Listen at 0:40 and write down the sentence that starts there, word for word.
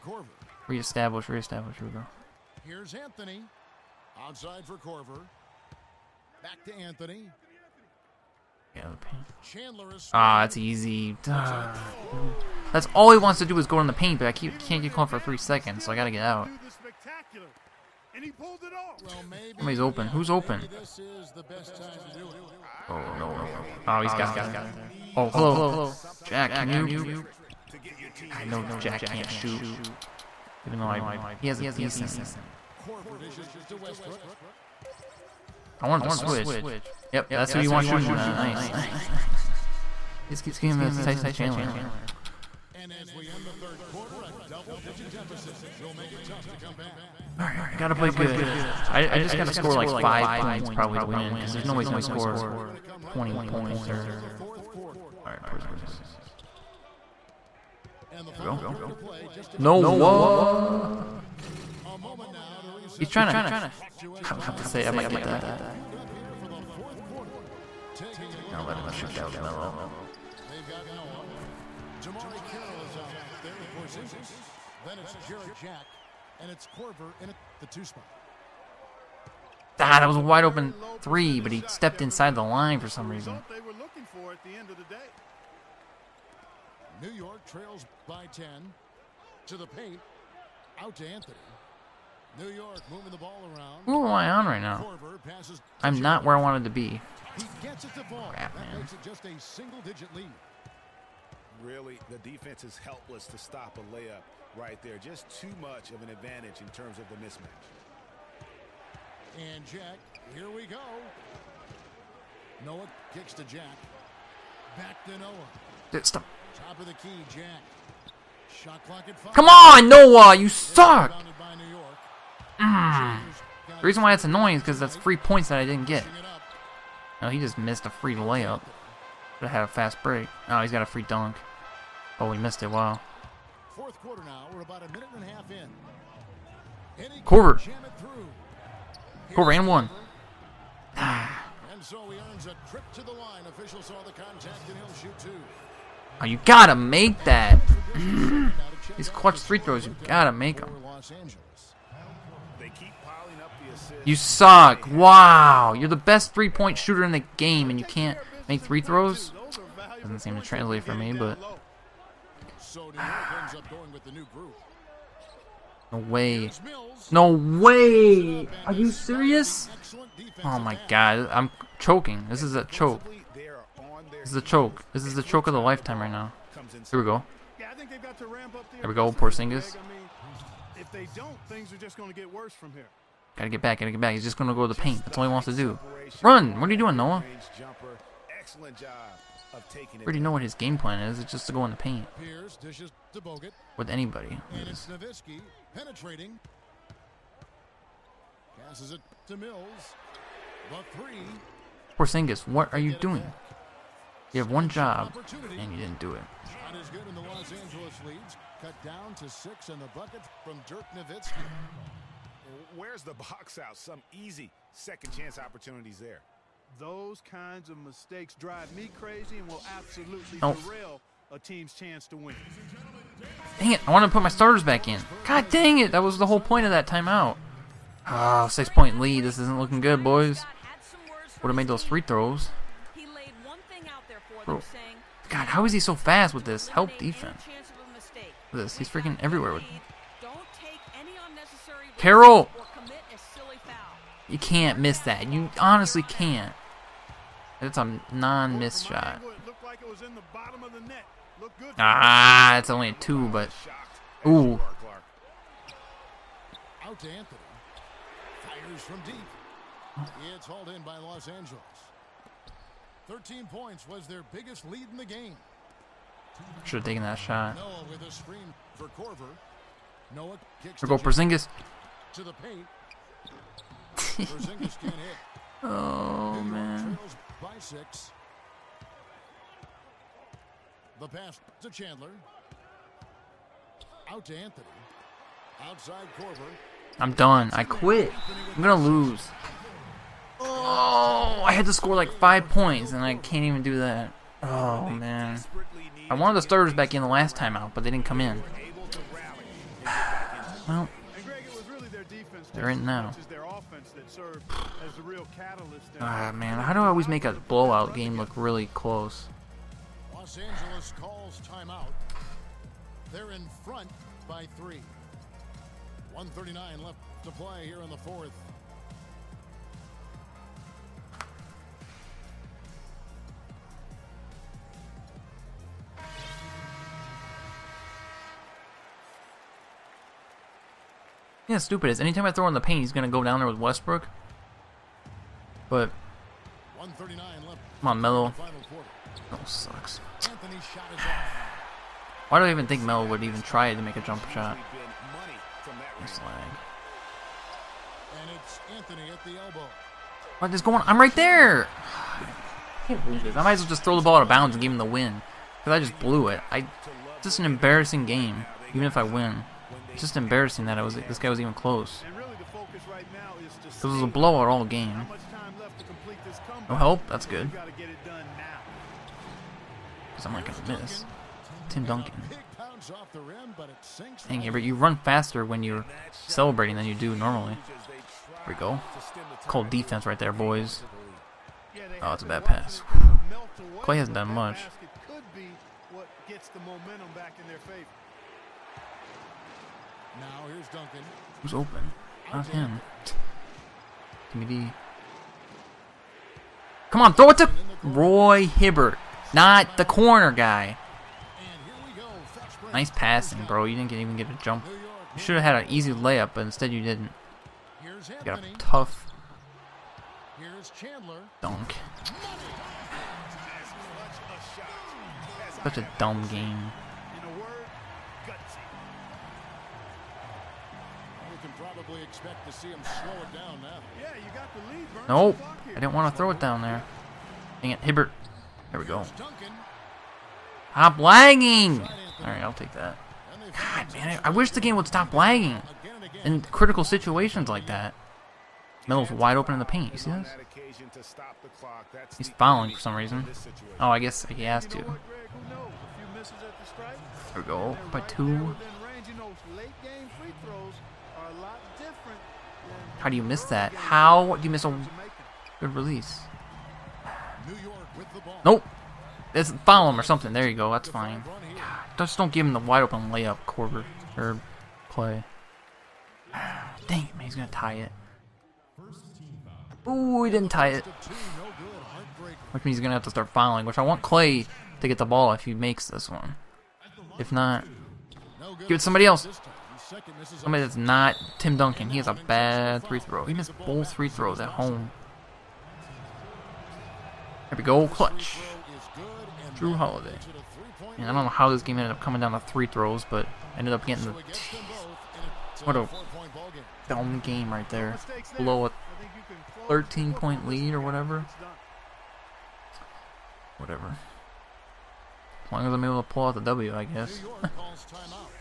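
He just keeps giving that to Tyson Chandler.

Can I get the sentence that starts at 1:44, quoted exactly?
Just too much of an advantage in terms of the mismatch.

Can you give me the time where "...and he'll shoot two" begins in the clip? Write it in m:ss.
2:24.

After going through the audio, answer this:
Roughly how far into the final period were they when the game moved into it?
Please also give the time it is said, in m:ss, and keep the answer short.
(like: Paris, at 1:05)
a minute and a half, at 2:14.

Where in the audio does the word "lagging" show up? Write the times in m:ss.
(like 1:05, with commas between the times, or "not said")
7:10, 7:15.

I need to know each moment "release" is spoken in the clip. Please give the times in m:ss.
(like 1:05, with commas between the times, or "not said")
7:35.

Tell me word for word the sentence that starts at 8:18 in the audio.
Below a 13 point lead or whatever.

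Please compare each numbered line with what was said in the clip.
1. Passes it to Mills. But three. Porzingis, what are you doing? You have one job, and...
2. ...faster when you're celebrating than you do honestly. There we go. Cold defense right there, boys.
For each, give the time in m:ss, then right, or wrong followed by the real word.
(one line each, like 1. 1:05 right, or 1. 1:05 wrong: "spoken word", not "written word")
1. 3:18 right
2. 6:14 wrong: "normally", not "honestly".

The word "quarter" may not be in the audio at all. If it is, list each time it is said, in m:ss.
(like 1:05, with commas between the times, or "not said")
0:43, 2:14.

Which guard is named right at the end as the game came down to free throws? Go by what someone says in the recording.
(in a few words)
Jrue Holiday.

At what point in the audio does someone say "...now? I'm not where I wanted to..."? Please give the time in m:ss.
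1:34.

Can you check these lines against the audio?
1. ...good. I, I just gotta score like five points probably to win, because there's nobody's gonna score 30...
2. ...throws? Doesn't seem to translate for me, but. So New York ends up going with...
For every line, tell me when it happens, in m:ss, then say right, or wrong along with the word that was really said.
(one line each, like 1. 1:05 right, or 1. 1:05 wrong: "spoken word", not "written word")
1. 0:48 wrong: "20", not "30"
2. 2:38 right.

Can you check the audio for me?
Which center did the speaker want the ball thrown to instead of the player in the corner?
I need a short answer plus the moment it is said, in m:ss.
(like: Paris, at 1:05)
Roy Hibbert, at 6:37.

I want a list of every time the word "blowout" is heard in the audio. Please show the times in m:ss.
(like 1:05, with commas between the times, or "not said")
5:07, 6:04.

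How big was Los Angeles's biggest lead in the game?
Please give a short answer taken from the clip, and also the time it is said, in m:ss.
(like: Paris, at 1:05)
13 points, at 4:23.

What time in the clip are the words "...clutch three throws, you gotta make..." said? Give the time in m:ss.
2:29.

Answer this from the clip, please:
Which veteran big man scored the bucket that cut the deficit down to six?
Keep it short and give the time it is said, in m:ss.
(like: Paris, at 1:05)
Dirk Nowitzki, at 3:30.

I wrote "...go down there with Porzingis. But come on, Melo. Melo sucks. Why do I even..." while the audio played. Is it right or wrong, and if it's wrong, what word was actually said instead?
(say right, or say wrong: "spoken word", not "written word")
wrong: "Westbrook", not "Porzingis".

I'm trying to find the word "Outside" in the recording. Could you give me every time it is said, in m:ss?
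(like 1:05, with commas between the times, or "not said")
0:04, 4:45.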